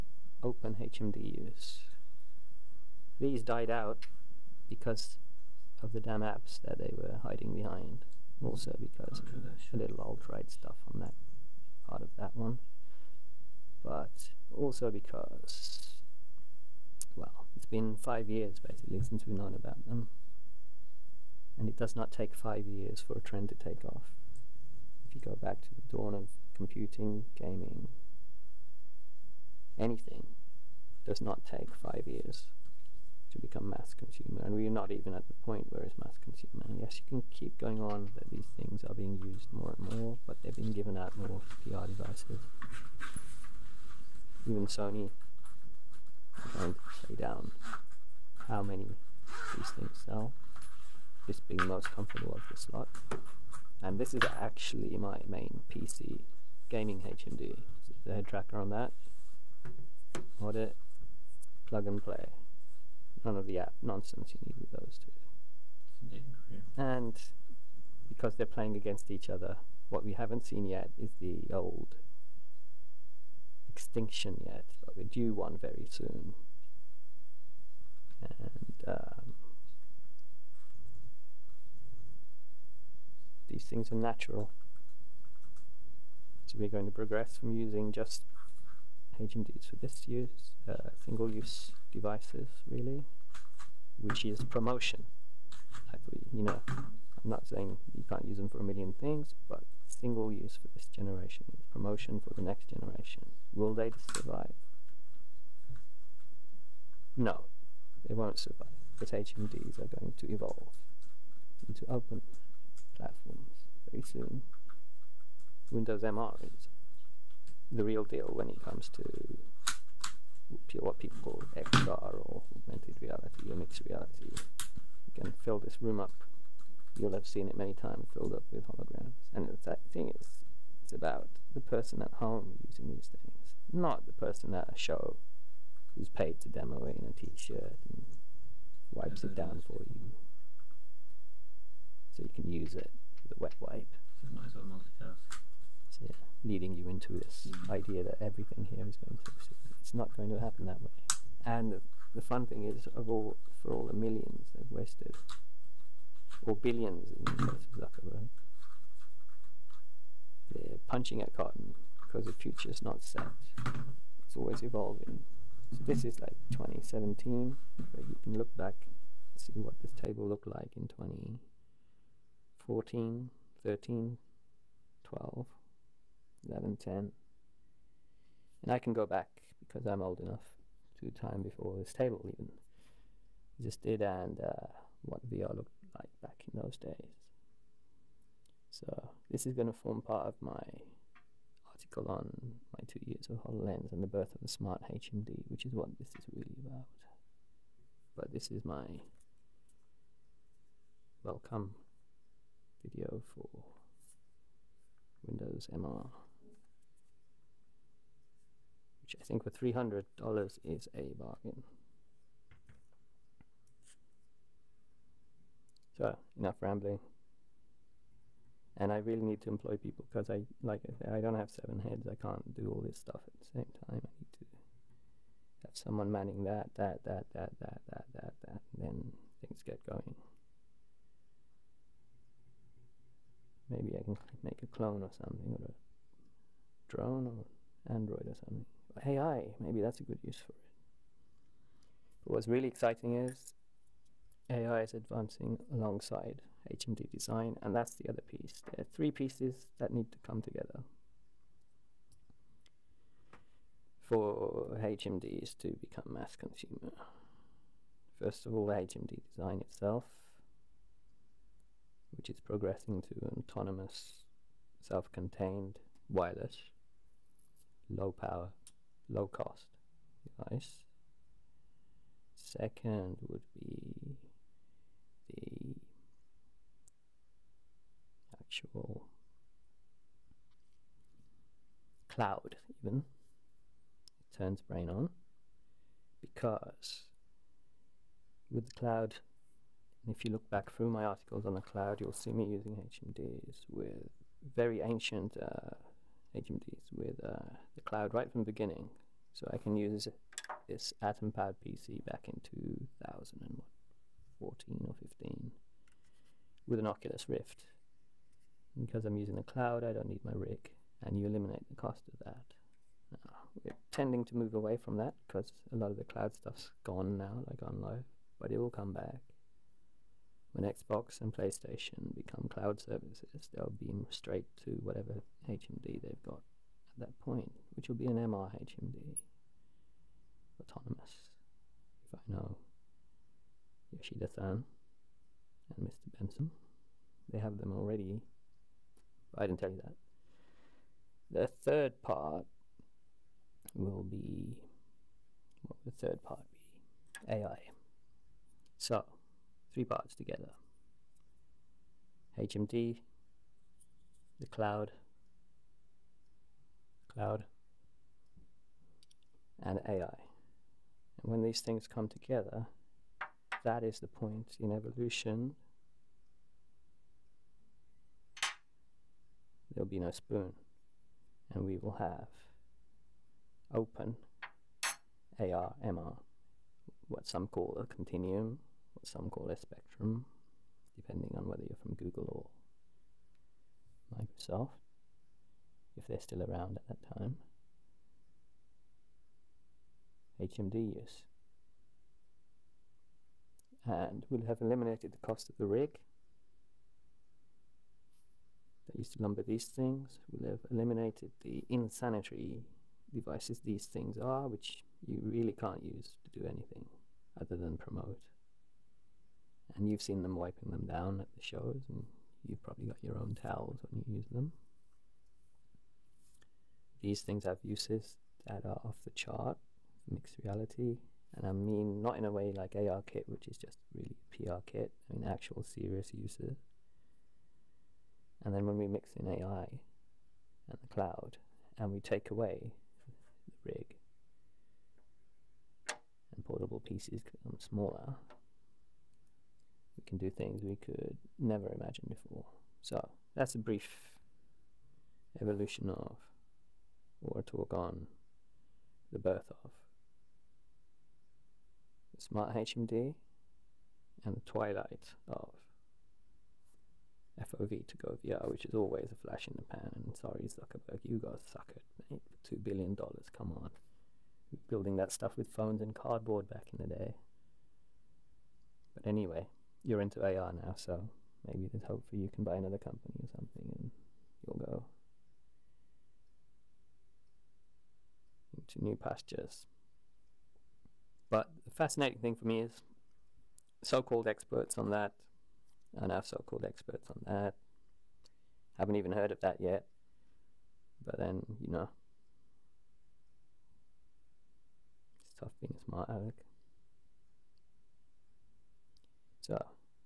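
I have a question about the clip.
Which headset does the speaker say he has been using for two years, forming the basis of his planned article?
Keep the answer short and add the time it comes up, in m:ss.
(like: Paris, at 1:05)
HoloLens, at 3:13.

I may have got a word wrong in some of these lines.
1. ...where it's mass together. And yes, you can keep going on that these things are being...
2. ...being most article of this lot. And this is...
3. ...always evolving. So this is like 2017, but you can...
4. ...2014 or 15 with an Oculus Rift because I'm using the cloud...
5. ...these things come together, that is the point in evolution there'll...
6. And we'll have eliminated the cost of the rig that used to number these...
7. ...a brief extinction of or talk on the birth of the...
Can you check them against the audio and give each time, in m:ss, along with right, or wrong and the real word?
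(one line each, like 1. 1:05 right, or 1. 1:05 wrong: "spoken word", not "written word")
1. 0:35 wrong: "consumer", not "together"
2. 0:51 wrong: "comfortable", not "article"
3. 2:44 right
4. 5:02 right
5. 6:01 right
6. 6:33 right
7. 7:23 wrong: "evolution", not "extinction".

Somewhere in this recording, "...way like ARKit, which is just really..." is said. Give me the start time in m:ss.
7:02.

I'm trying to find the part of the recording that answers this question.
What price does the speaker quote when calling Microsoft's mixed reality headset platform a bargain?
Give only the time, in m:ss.
3:29.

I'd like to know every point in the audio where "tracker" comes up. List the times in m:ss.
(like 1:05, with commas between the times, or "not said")
0:58.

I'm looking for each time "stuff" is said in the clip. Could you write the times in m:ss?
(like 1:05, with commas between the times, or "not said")
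0:10, 3:42, 5:16, 7:45.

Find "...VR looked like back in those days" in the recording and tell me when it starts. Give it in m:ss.
3:05.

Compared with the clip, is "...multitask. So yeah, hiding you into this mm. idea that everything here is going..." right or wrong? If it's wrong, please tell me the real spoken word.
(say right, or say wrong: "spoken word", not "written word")
wrong: "leading", not "hiding".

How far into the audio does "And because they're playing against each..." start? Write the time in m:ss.
1:06.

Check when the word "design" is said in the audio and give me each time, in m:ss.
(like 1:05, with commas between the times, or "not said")
4:07, 4:19.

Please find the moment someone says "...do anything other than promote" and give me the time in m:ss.
6:46.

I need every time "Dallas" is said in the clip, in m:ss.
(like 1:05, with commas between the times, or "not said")
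not said.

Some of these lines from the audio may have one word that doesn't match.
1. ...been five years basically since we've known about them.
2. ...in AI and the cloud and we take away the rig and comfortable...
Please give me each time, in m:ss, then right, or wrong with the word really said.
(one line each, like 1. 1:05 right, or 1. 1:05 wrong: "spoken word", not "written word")
1. 0:17 right
2. 7:09 wrong: "portable", not "comfortable".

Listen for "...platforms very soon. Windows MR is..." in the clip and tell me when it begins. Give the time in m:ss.
1:52.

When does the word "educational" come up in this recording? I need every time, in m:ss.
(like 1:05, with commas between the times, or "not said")
not said.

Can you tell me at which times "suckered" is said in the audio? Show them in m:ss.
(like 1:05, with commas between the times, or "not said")
7:41.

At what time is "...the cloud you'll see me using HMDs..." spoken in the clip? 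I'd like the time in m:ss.
4:51.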